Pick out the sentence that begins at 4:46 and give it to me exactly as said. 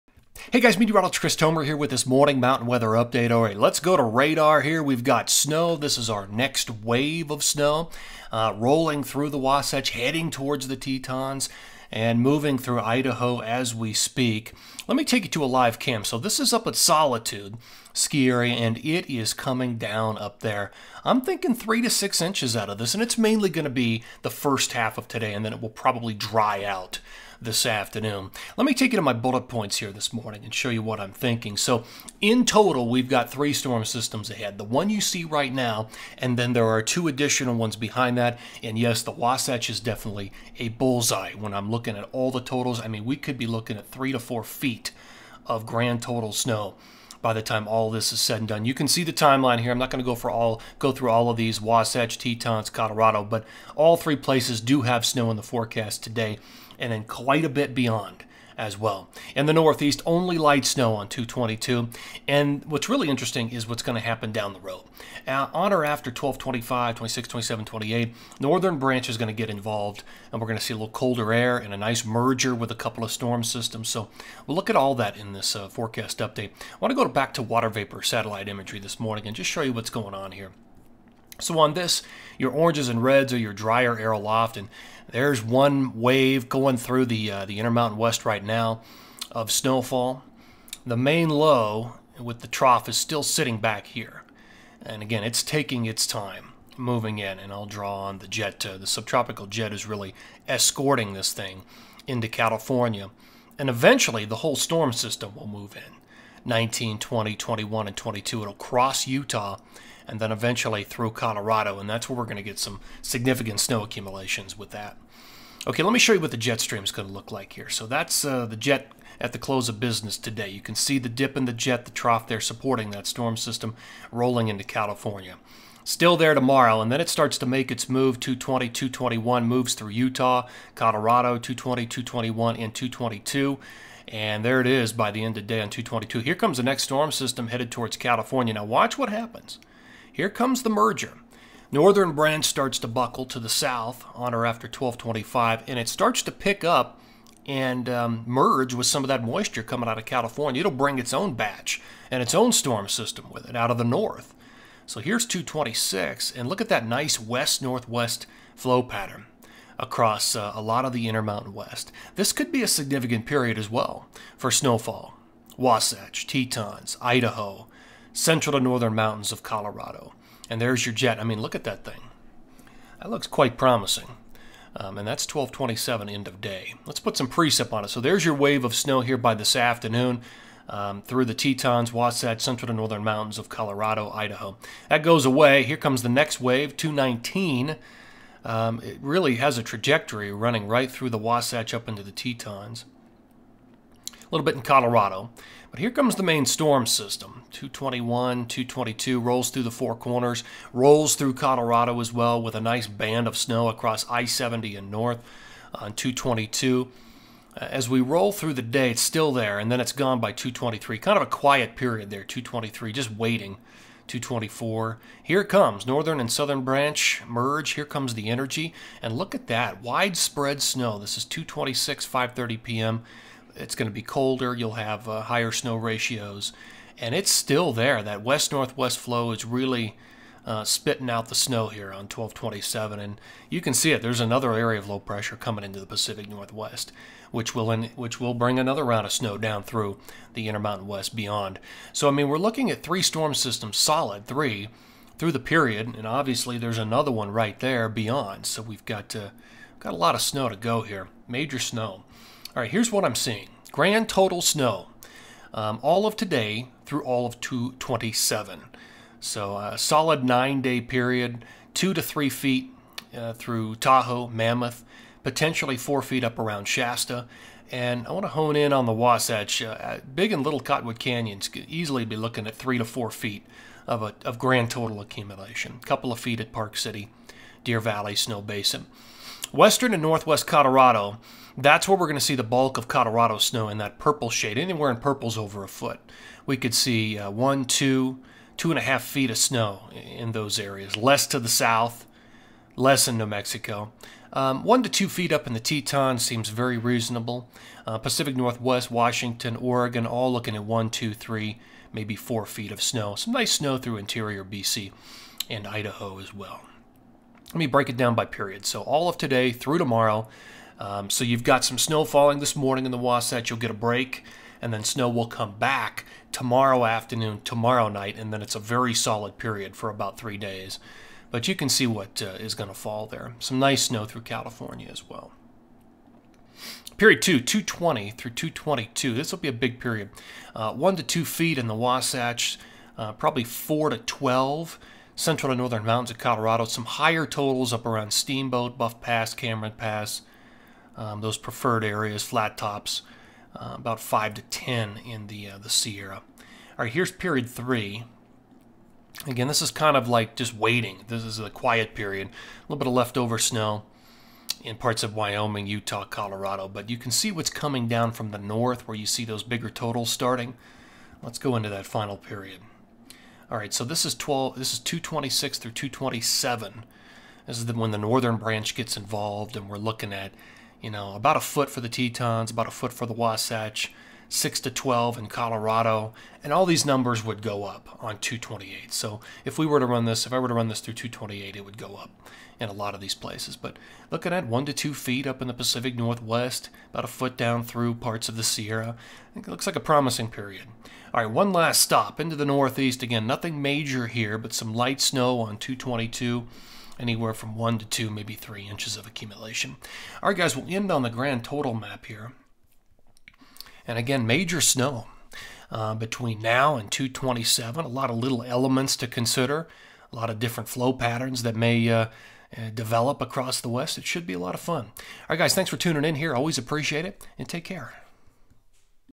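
We could see uh, one, two, two and a half feet of snow in those areas.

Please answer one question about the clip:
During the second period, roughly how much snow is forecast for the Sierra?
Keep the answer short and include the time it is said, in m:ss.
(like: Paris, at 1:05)
5 to 10 inches, at 5:43.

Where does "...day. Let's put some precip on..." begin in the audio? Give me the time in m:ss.
2:56.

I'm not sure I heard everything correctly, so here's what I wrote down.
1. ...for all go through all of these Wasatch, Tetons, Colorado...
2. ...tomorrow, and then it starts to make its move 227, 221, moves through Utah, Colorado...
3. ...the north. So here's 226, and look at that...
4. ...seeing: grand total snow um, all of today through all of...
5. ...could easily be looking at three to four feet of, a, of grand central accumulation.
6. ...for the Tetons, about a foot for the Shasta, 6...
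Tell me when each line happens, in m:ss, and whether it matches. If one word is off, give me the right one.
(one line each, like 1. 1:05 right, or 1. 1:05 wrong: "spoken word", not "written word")
1. 0:50 right
2. 2:06 wrong: "220", not "227"
3. 2:33 right
4. 4:13 right
5. 4:31 wrong: "total", not "central"
6. 6:11 wrong: "Wasatch", not "Shasta".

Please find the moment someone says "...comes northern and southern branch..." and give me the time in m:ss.
3:35.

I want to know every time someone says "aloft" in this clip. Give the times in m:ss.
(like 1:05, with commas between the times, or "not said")
1:24.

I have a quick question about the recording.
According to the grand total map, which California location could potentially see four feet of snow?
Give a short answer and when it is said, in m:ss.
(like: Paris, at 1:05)
Shasta, at 4:26.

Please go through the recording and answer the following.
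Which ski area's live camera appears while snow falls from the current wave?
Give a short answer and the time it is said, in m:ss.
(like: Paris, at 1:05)
Solitude, at 0:16.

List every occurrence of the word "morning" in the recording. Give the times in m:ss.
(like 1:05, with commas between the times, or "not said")
0:02, 0:30, 1:18, 5:12.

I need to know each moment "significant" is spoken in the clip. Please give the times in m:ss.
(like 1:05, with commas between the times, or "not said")
1:53, 2:42.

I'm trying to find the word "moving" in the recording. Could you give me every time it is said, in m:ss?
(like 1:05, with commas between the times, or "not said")
0:12, 1:36.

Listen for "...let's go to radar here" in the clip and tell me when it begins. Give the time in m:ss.
0:03.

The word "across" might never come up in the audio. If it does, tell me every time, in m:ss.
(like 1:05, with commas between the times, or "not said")
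2:39, 3:23, 6:53.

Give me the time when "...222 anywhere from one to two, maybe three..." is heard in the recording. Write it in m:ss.
6:35.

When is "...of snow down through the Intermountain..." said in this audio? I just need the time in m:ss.
3:59.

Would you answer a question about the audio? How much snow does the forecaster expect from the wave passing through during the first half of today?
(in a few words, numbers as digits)
3 to 6 inches.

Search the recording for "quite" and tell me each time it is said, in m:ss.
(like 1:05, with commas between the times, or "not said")
0:57, 2:53.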